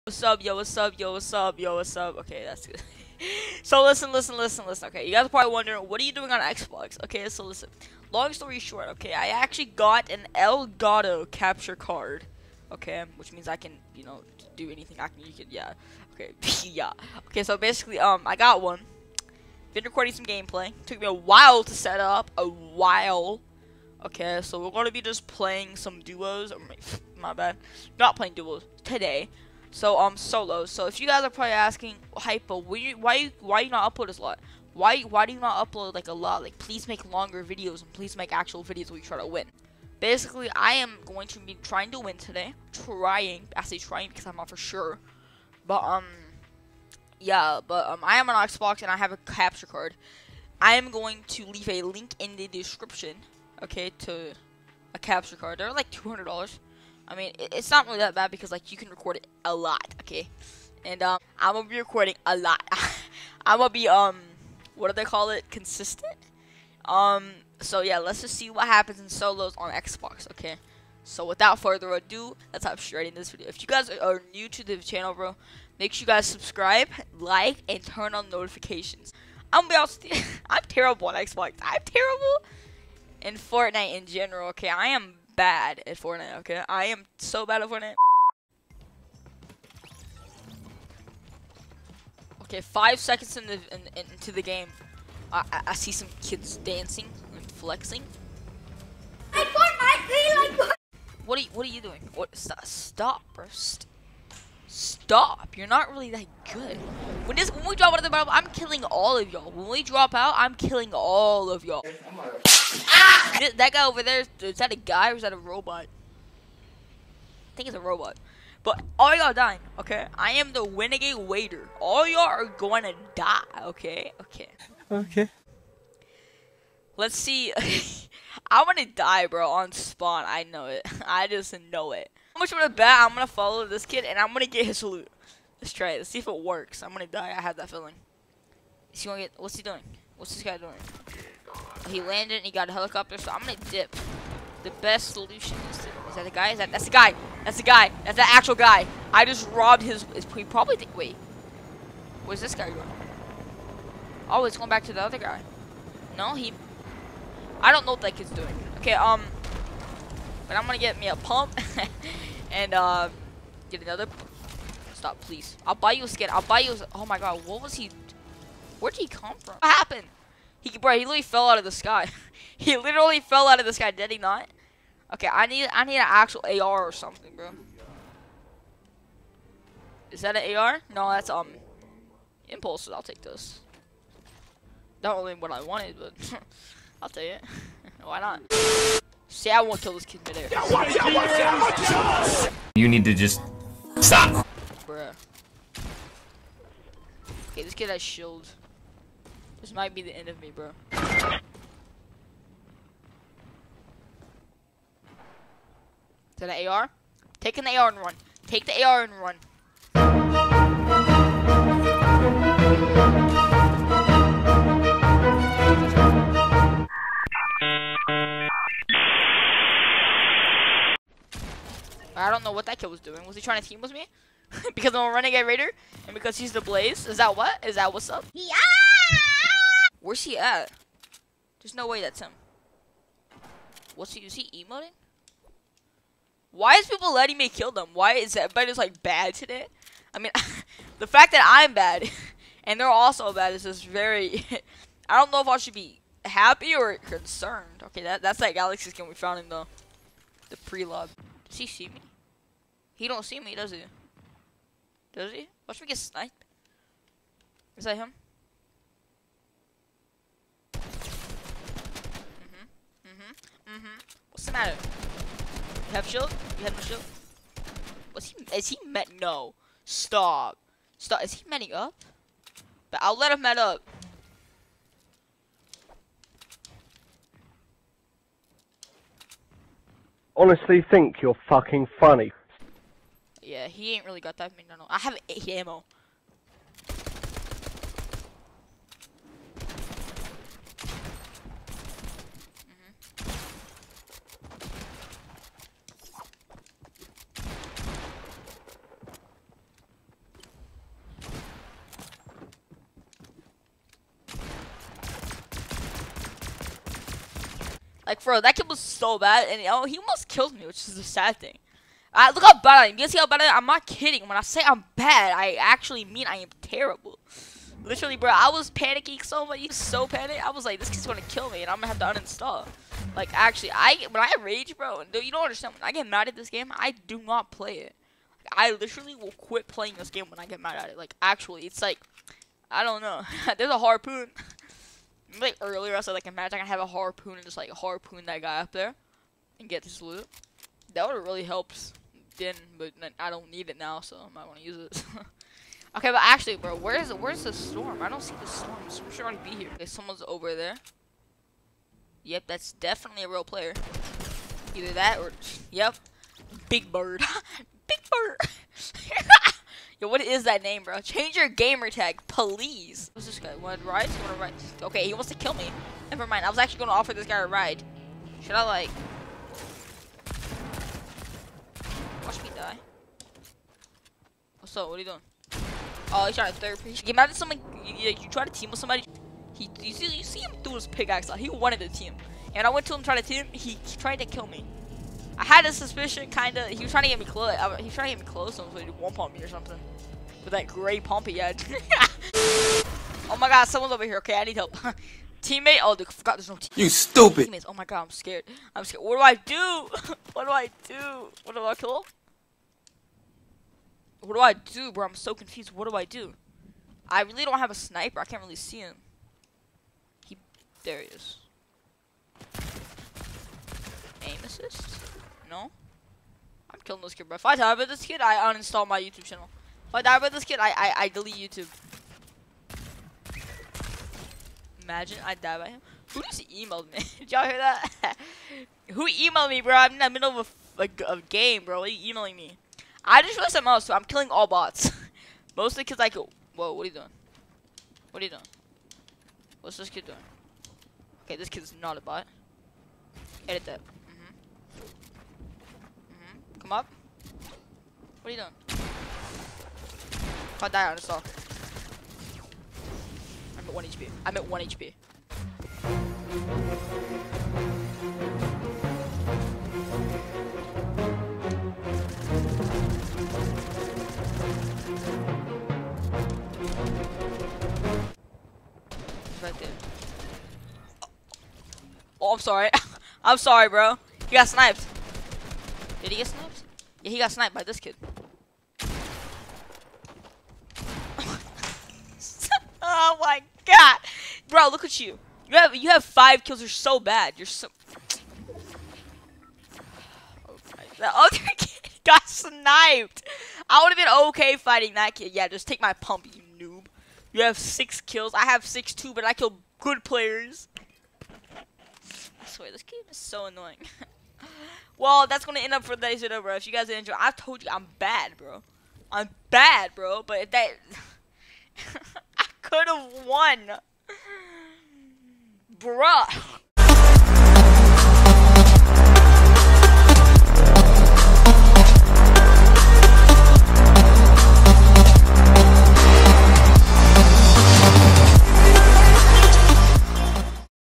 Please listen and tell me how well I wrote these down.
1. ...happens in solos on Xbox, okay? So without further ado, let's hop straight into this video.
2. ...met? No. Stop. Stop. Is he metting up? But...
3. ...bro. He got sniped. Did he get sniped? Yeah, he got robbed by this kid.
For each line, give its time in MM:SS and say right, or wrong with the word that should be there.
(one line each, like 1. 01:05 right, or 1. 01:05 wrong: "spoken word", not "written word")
1. 01:08 right
2. 04:28 right
3. 07:53 wrong: "sniped", not "robbed".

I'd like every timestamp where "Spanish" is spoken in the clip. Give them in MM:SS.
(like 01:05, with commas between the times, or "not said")
not said.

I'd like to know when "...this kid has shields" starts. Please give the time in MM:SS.
03:17.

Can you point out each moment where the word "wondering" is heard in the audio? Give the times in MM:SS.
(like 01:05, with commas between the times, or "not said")
00:05.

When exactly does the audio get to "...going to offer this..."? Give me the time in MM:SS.
06:06.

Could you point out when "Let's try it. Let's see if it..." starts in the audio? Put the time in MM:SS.
02:15.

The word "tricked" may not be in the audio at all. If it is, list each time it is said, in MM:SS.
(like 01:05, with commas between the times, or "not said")
not said.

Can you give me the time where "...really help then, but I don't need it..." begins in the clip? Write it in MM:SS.
05:41.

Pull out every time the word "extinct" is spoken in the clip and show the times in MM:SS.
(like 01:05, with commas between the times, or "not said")
not said.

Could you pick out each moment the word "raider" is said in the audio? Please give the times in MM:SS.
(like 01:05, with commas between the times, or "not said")
02:01, 03:45.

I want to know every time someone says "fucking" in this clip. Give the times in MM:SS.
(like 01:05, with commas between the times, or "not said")
04:41.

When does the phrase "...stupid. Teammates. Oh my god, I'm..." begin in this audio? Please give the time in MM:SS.
06:36.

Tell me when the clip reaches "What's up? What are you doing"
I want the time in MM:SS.
06:14.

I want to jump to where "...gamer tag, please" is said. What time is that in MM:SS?
06:01.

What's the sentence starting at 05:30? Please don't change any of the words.
Like, actually, it's like, I don't know.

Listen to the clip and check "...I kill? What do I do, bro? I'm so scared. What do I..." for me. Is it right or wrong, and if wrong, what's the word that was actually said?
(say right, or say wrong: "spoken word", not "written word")
wrong: "confused", not "scared".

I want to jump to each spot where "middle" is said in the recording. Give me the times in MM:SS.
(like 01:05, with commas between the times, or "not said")
07:10.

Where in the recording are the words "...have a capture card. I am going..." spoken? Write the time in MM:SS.
00:48.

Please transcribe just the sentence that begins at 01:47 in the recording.
When this, when we drop out of the battle, I'm killing all of y'all.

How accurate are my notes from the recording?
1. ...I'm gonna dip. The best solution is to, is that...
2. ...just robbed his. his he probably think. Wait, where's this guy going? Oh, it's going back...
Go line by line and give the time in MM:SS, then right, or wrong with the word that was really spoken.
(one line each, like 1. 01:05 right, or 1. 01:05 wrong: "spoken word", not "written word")
1. 02:23 right
2. 02:29 right.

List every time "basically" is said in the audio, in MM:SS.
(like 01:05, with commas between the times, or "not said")
00:17, 00:40.